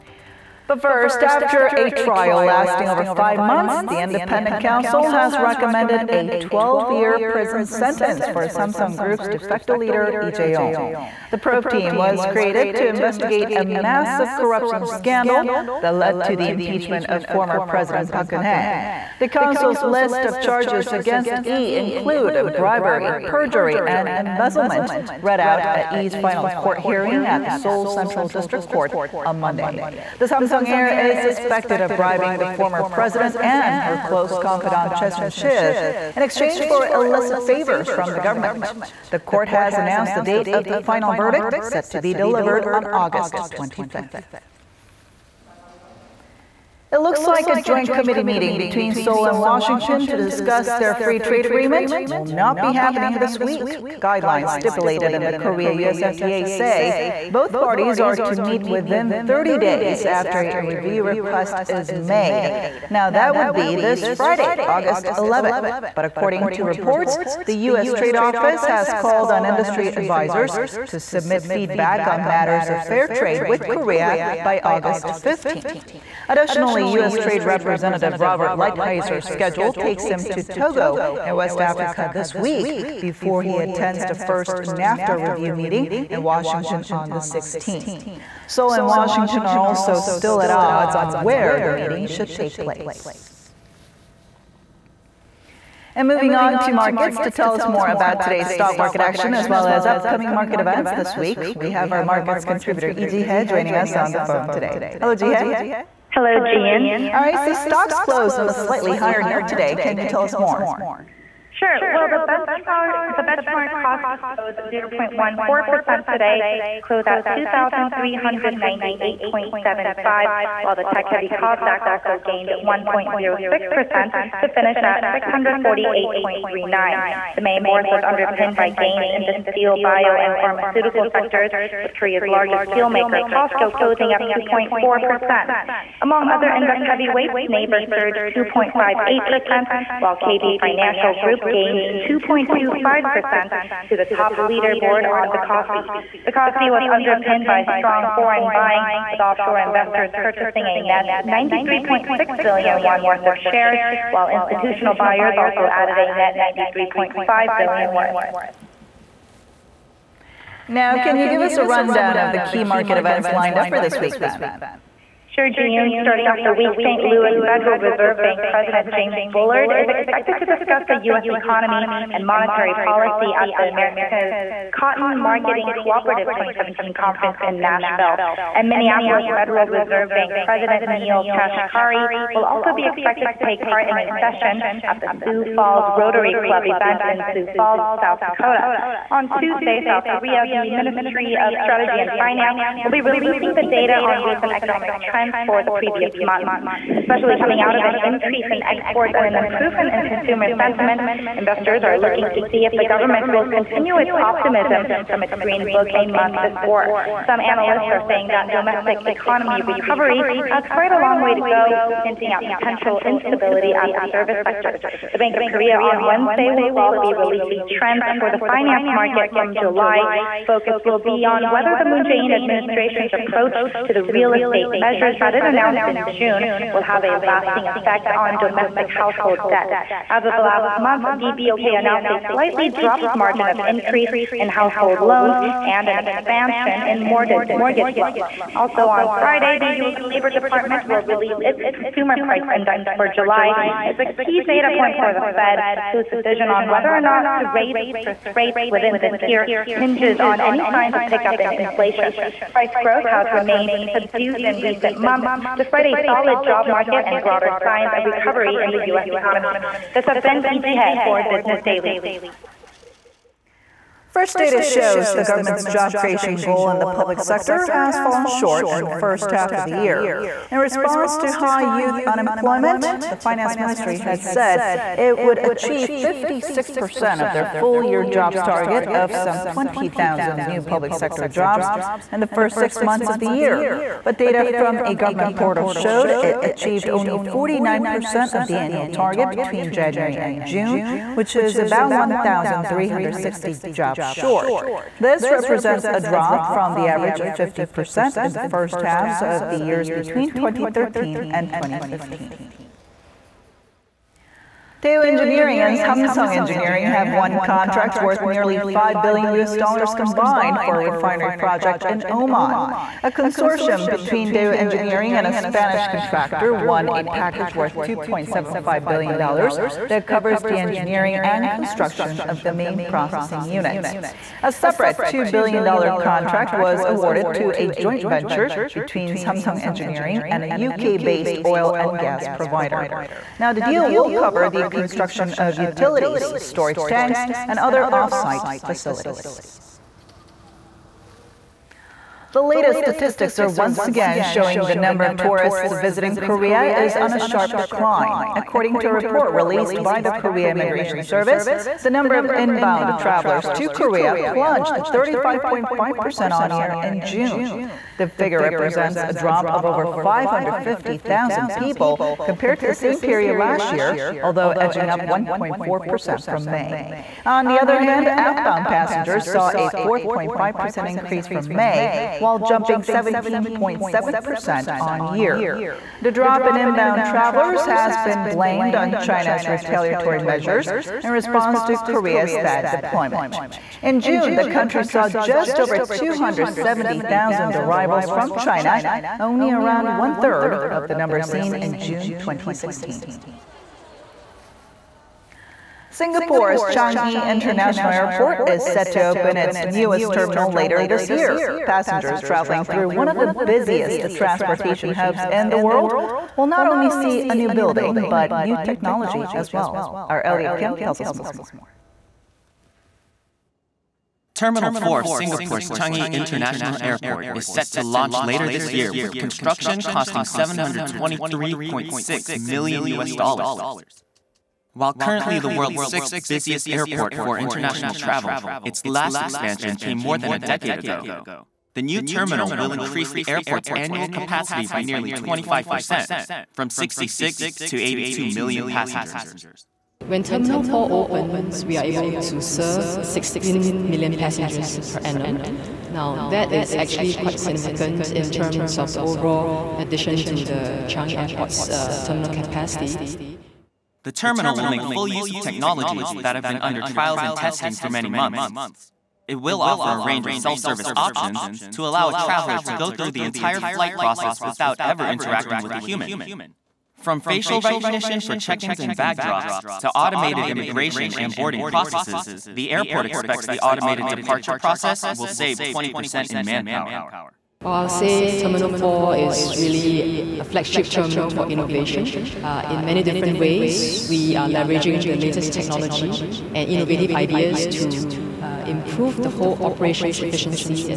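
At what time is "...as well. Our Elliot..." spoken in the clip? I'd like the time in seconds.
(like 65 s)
409 s.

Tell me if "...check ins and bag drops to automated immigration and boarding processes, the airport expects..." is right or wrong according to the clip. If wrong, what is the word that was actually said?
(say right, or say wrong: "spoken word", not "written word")
right.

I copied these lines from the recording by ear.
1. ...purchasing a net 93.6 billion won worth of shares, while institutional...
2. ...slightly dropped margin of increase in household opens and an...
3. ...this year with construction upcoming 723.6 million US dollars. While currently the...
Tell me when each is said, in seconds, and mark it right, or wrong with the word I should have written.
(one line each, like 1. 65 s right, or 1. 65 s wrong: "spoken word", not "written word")
1. 150 s right
2. 232 s wrong: "loans", not "opens"
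3. 418 s wrong: "costing", not "upcoming".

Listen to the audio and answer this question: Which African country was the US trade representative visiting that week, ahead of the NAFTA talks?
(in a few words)
Togo.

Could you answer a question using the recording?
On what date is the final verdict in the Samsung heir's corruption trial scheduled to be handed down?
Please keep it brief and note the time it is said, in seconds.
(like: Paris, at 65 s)
August 25th, at 42 s.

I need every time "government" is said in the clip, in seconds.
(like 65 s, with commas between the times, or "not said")
38 s, 202 s, 265 s, 284 s.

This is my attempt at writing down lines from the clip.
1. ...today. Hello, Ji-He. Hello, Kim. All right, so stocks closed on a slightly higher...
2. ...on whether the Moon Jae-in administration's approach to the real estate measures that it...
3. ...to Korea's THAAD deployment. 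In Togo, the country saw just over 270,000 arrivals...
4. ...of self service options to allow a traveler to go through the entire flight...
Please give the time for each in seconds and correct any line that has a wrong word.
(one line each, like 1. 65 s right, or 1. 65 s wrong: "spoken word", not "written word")
1. 104 s wrong: "Gian", not "Kim"
2. 221 s right
3. 381 s wrong: "June", not "Togo"
4. 460 s right.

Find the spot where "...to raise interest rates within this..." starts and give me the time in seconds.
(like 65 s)
247 s.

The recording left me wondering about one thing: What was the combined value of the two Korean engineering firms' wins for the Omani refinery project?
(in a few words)
nearly 5 billion US dollars.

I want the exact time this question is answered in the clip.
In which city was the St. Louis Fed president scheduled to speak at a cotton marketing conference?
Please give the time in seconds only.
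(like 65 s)
177 s.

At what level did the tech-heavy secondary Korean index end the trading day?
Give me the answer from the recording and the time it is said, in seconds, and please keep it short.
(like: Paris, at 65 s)
648.39, at 125 s.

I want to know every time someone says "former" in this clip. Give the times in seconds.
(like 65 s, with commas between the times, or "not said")
17 s, 32 s.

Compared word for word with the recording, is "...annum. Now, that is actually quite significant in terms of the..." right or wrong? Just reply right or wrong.
right.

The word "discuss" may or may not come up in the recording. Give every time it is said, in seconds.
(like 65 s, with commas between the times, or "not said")
50 s, 170 s.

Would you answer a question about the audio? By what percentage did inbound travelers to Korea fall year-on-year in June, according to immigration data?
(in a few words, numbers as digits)
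35.5%.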